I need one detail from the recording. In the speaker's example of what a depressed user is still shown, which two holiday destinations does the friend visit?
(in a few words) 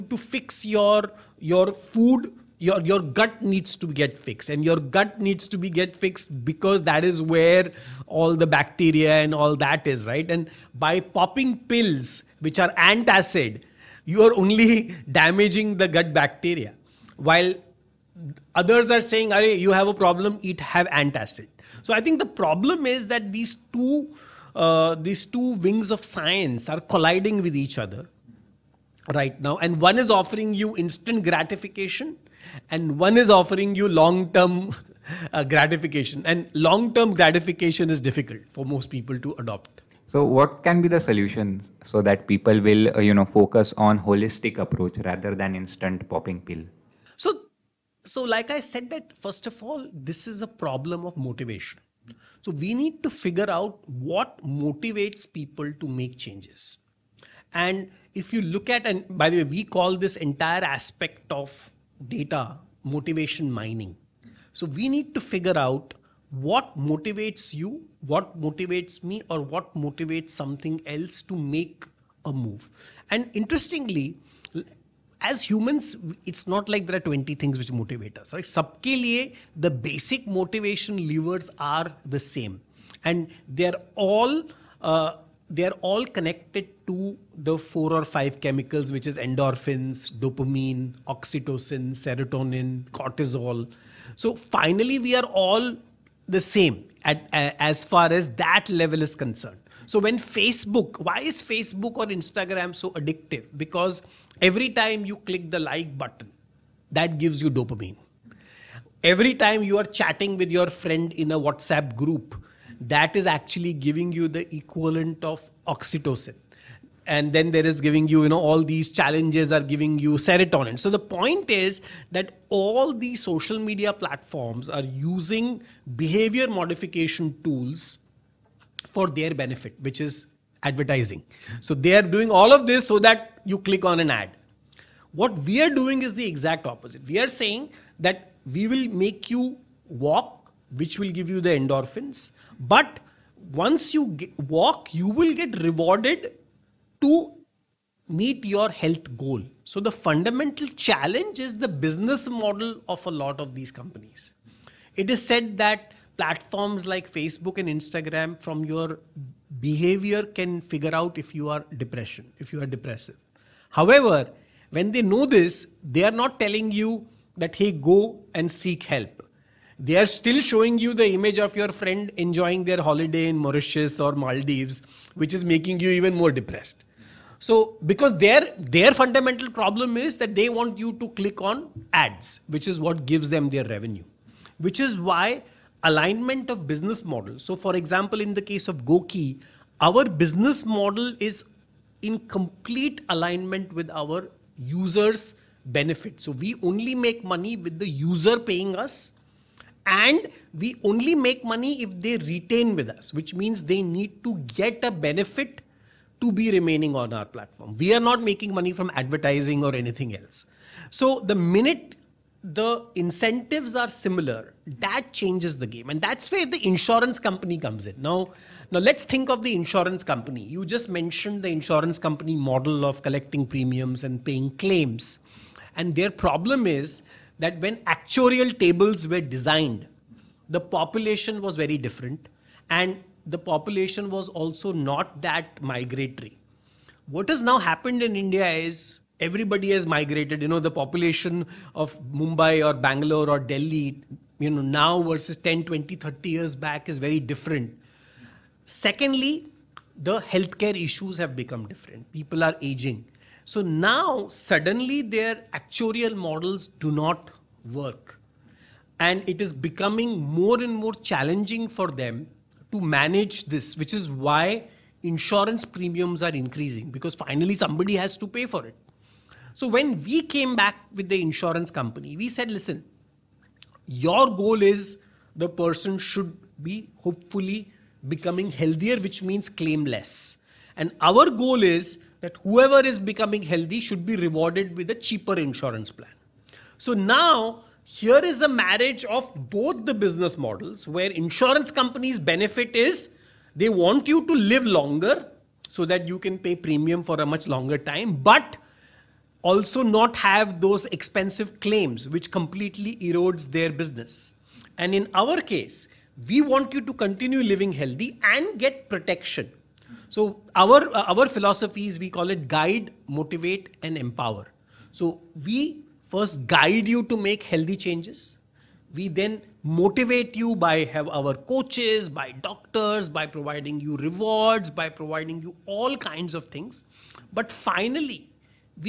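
Mauritius or Maldives.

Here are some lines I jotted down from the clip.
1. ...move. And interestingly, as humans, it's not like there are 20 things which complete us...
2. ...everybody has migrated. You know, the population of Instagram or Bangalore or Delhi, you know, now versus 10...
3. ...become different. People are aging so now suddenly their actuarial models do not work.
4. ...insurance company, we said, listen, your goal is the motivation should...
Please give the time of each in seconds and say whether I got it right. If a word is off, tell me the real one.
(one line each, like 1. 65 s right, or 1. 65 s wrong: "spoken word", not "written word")
1. 72 s wrong: "motivate", not "complete"
2. 239 s wrong: "Mumbai", not "Instagram"
3. 251 s right
4. 271 s wrong: "person", not "motivation".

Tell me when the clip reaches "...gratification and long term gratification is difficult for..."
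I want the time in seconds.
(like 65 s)
35 s.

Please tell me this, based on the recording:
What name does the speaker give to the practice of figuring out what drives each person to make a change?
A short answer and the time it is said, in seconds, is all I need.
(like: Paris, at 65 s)
motivation mining, at 62 s.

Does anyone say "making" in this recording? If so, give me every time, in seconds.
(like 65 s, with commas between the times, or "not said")
175 s, 208 s.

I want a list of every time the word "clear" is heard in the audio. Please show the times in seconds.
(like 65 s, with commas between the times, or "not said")
not said.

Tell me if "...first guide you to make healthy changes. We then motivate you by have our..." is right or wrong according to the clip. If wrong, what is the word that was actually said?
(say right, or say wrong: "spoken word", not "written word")
right.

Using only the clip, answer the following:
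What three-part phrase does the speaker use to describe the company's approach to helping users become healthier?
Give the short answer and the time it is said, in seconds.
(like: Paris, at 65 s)
guide, motivate, and empower, at 312 s.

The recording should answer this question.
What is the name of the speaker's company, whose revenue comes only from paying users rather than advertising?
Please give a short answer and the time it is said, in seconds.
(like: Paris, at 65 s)
GOQii, at 188 s.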